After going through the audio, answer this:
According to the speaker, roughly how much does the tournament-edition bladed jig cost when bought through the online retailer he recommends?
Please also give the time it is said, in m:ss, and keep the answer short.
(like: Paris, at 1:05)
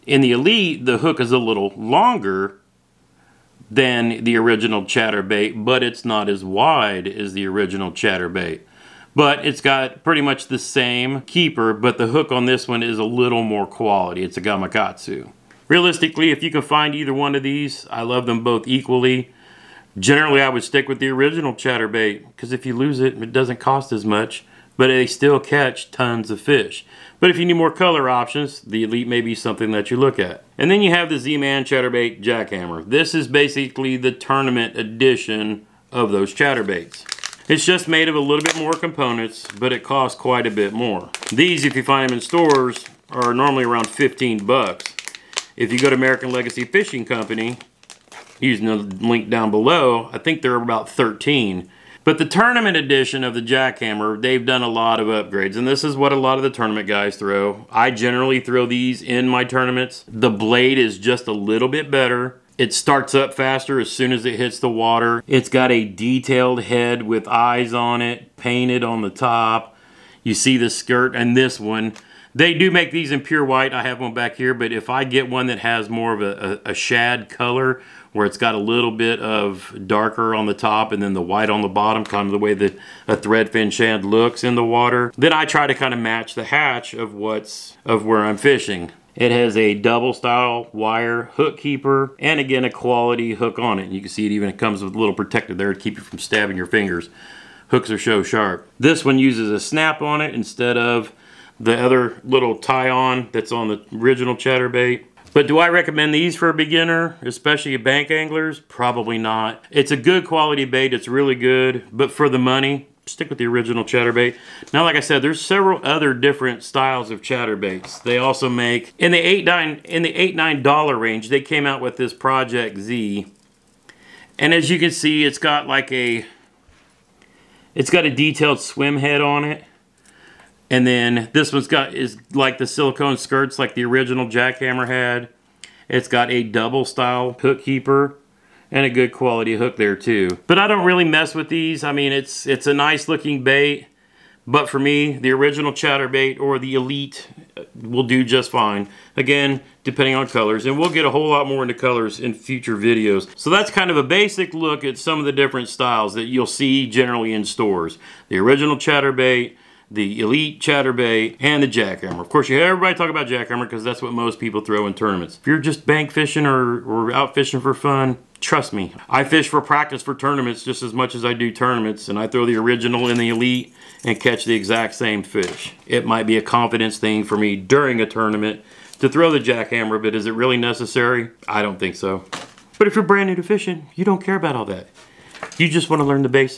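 13, at 0:50.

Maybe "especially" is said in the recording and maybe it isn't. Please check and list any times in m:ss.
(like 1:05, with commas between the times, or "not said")
1:47.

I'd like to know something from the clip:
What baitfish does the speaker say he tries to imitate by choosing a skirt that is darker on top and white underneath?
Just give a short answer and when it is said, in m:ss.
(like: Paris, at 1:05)
threadfin shad, at 1:23.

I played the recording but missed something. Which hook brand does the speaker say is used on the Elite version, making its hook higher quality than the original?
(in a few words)
Gamakatsu.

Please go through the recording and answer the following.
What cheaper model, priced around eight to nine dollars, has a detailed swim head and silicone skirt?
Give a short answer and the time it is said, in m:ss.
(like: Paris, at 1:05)
Project Z, at 2:02.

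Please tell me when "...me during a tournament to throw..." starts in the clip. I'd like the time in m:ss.
2:57.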